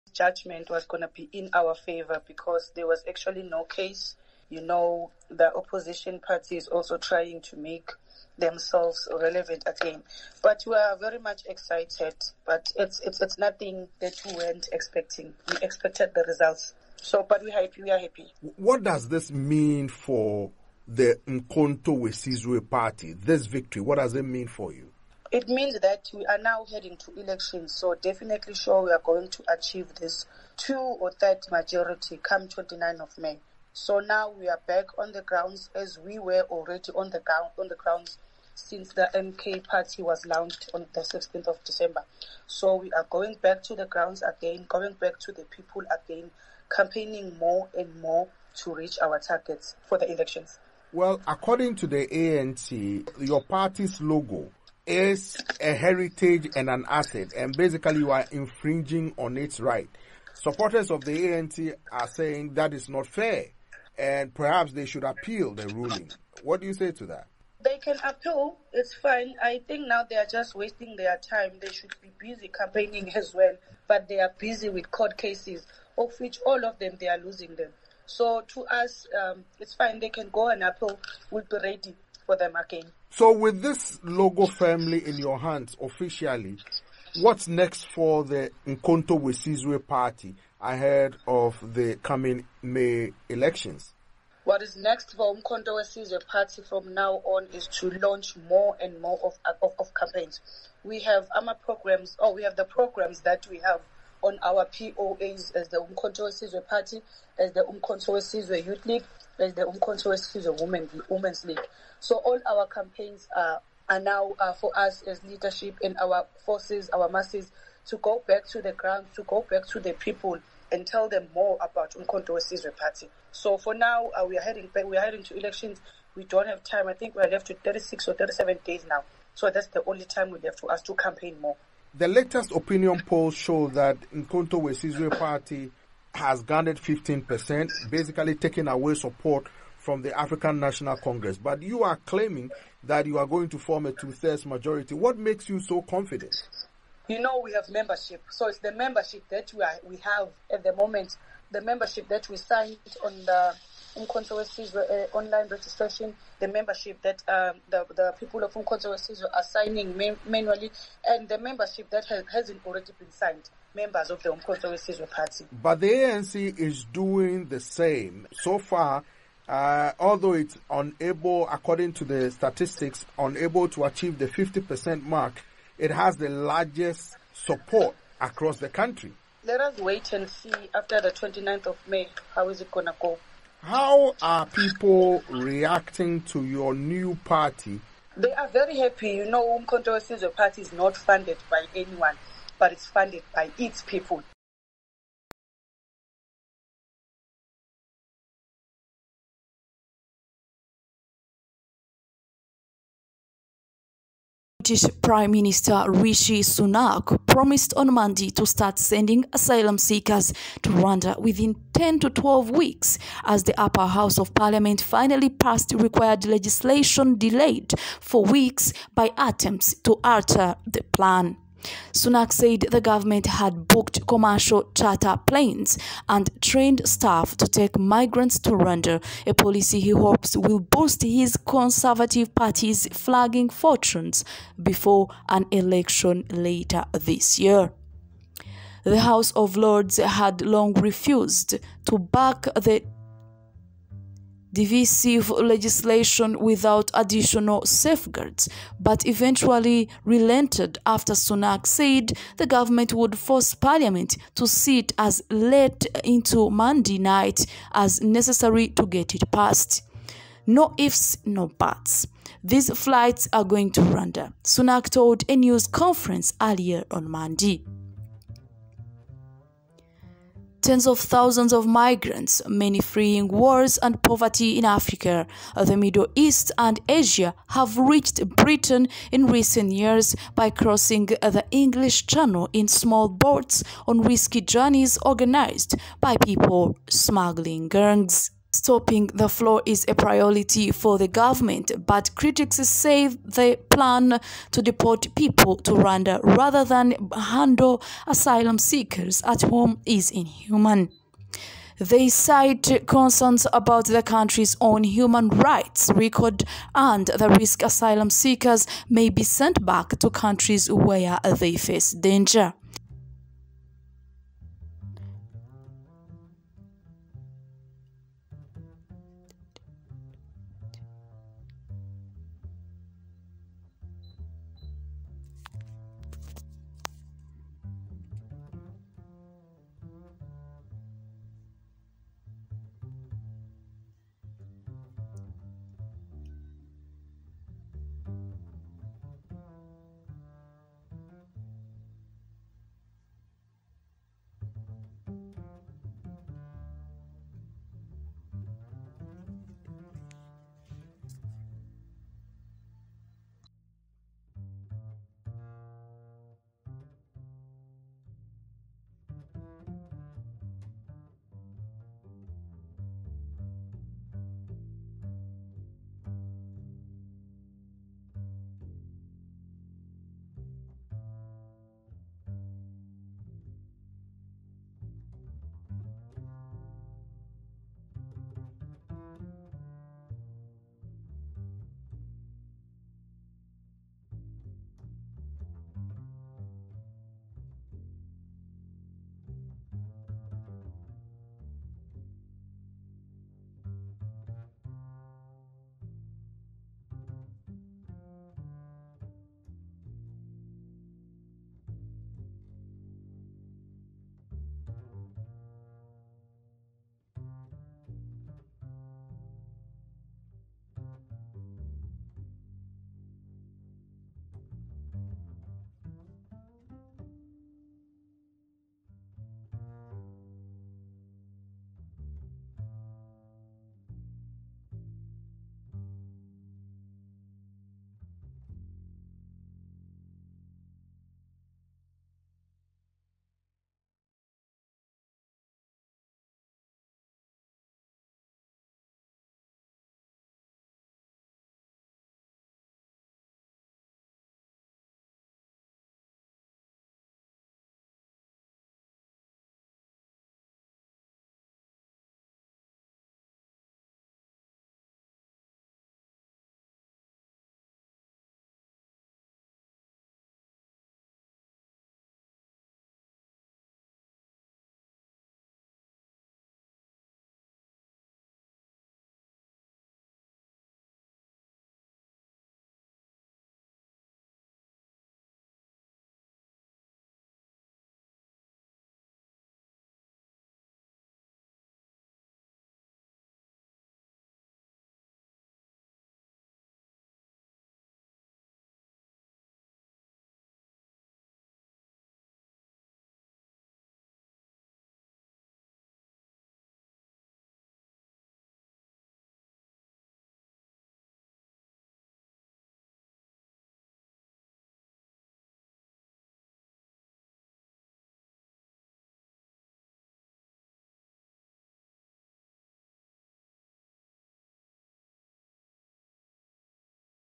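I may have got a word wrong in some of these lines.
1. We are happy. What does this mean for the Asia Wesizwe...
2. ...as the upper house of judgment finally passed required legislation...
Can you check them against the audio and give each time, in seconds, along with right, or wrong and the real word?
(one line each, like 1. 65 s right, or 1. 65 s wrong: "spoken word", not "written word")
1. 17 s wrong: "Umkhonto", not "Asia"
2. 213 s wrong: "parliament", not "judgment".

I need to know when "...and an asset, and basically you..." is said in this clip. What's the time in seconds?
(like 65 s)
56 s.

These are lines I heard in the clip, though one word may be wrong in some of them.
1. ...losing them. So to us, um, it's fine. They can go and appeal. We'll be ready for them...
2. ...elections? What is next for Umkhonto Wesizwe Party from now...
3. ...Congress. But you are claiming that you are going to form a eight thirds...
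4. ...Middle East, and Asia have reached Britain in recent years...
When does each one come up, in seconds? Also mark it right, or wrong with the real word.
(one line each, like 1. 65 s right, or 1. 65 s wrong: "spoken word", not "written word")
1. 77 s right
2. 93 s right
3. 140 s wrong: "two", not "eight"
4. 275 s right.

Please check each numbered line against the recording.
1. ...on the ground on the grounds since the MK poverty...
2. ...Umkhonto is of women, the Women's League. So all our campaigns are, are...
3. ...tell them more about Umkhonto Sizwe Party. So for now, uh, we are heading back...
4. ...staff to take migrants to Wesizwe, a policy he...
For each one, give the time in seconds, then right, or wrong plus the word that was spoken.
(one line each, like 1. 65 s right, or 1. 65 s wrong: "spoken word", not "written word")
1. 36 s wrong: "party", not "poverty"
2. 109 s right
3. 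120 s right
4. 226 s wrong: "Rwanda", not "Wesizwe".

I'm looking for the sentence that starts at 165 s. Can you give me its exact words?
But the ANC is doing the same.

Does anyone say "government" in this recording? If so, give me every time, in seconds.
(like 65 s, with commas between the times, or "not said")
222 s, 252 s, 291 s.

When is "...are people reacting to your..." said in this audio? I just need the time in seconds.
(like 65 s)
184 s.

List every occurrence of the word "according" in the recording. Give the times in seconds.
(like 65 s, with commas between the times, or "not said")
51 s, 171 s.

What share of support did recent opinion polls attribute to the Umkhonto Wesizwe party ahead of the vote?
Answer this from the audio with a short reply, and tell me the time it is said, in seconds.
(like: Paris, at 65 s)
15%, at 136 s.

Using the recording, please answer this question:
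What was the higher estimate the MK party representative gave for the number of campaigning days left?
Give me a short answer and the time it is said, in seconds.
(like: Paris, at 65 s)
37, at 128 s.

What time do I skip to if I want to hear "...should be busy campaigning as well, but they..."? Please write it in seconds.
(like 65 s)
71 s.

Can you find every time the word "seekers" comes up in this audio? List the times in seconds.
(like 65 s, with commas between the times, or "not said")
209 s, 298 s, 308 s.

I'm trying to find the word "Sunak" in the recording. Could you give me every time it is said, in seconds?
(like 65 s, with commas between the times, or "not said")
206 s, 221 s, 251 s, 264 s.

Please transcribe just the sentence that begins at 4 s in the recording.
You know, the opposition party is also trying to make themselves relevant again.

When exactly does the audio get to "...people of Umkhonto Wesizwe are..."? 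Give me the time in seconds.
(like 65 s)
158 s.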